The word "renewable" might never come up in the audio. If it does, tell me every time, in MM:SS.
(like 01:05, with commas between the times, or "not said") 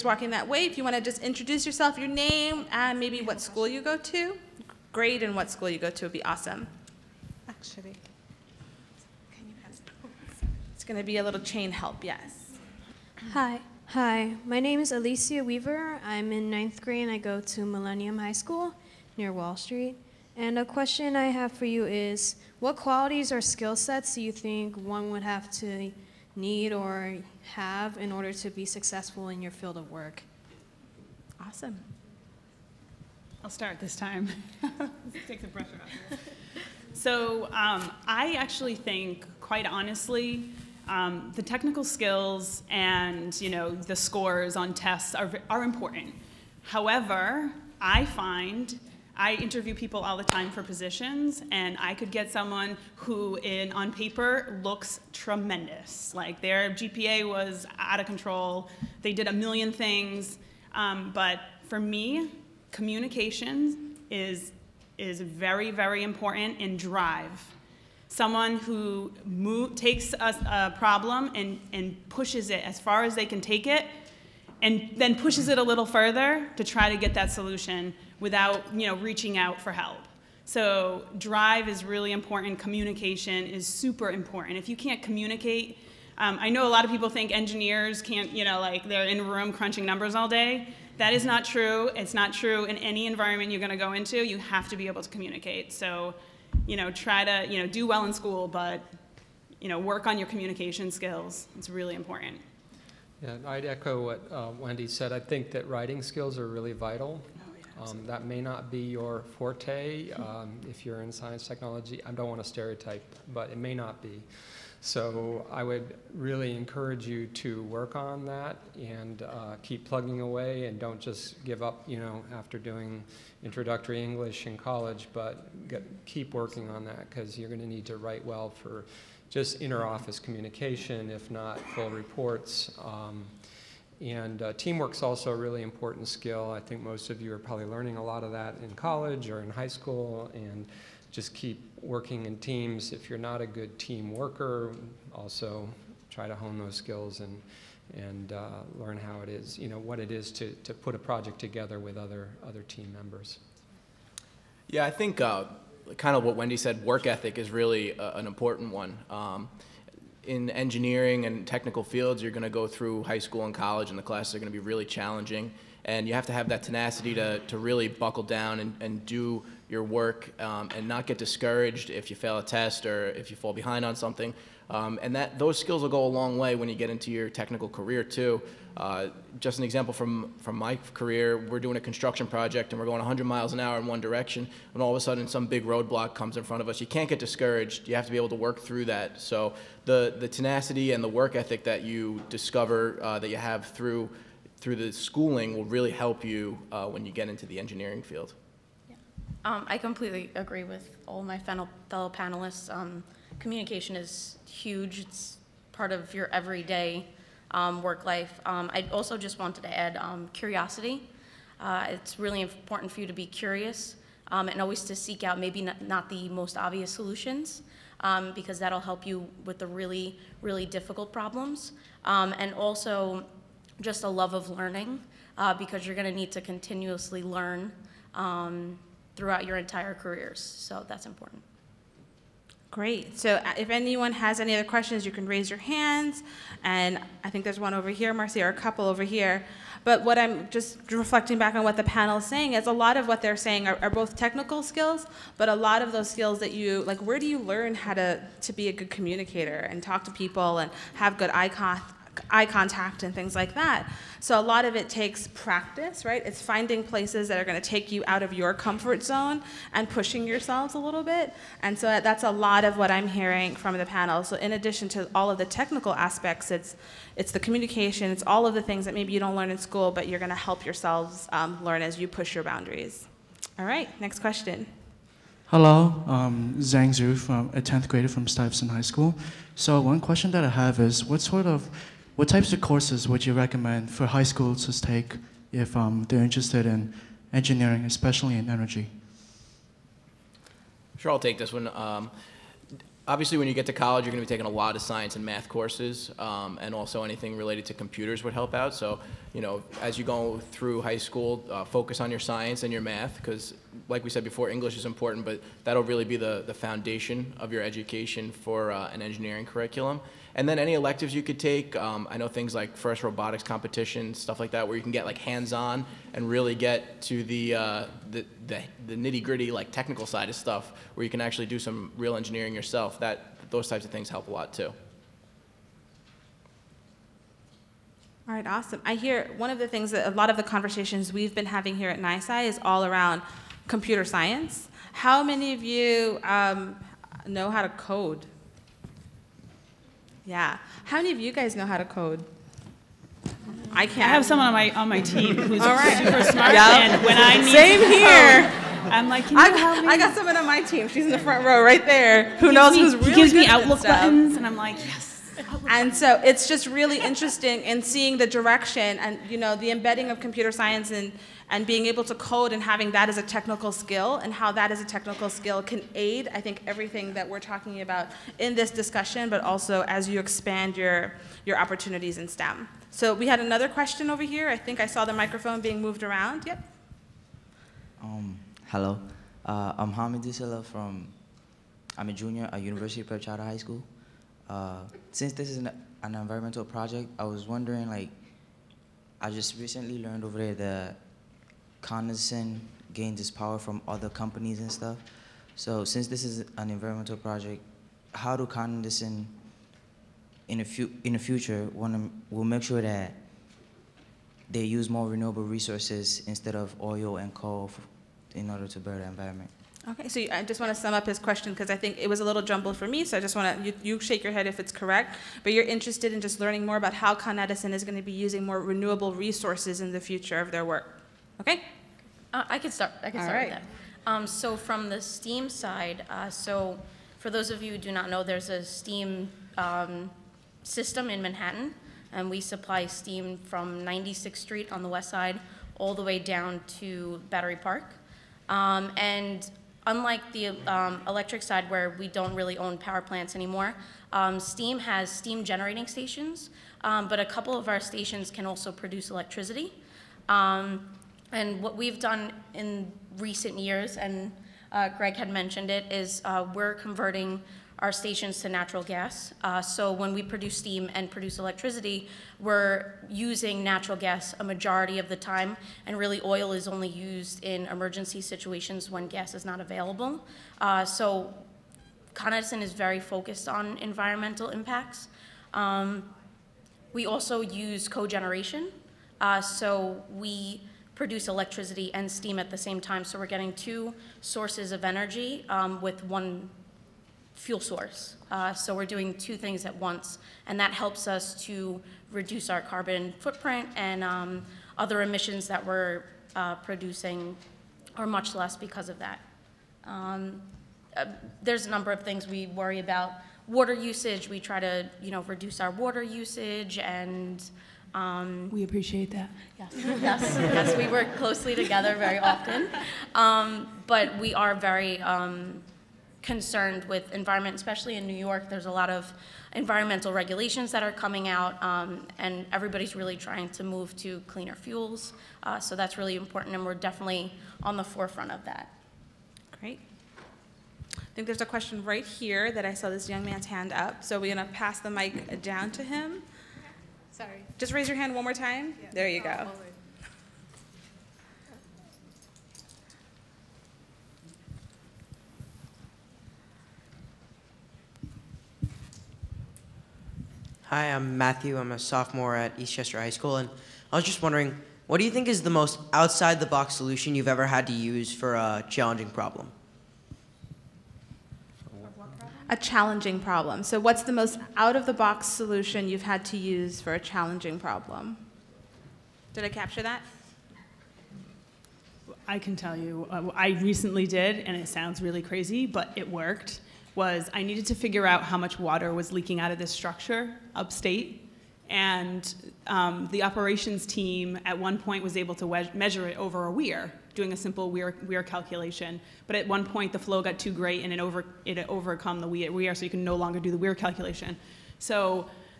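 06:45, 06:58.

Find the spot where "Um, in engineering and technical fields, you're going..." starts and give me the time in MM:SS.
02:39.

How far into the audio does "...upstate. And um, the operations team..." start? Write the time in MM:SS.
09:40.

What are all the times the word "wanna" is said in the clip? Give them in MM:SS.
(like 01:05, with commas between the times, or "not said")
06:41.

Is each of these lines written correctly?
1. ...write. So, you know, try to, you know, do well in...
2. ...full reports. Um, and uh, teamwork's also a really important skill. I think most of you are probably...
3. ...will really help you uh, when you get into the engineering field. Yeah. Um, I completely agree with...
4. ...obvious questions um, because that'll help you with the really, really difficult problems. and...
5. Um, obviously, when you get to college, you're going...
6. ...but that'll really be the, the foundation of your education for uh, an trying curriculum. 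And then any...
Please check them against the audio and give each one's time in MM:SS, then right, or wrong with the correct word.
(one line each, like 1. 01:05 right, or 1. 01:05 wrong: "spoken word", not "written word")
1. 01:35 wrong: "communicate", not "write"
2. 02:11 right
3. 03:15 right
4. 03:36 wrong: "solutions", not "questions"
5. 04:51 right
6. 05:05 wrong: "engineering", not "trying".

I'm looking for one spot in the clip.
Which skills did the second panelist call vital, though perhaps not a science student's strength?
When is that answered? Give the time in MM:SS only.
01:45.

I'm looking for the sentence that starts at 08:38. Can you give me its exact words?
There's a lot of environmental regulations that are coming out, um, and everybody's really trying to move to cleaner fuels.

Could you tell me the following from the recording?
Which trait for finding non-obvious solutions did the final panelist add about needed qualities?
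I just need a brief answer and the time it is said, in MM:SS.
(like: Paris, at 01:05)
Curiosity, at 03:30.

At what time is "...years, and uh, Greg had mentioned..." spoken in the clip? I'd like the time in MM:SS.
07:33.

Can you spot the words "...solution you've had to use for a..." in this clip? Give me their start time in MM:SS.
09:25.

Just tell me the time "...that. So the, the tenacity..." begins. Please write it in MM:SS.
03:08.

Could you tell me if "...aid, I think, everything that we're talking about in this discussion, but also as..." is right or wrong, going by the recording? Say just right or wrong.
right.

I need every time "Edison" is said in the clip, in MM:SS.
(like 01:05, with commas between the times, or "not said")
06:32, 06:38, 06:57, 07:52.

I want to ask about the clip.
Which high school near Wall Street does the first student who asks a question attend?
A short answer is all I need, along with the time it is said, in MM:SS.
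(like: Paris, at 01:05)
Millennium High School, at 00:17.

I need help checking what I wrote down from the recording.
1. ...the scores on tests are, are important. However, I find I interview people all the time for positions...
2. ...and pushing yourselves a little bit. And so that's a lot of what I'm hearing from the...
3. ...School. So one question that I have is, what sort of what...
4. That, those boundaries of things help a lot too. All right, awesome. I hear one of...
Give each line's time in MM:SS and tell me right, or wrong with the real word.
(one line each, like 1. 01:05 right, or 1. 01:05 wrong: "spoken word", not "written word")
1. 00:43 right
2. 04:19 right
3. 04:38 right
4. 05:22 wrong: "types", not "boundaries".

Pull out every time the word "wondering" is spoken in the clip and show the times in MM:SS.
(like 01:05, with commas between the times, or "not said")
06:27, 09:14.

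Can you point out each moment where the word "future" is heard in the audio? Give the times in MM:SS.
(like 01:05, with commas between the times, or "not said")
06:41, 07:00.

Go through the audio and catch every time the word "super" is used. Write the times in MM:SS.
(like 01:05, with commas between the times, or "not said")
01:23, 05:45.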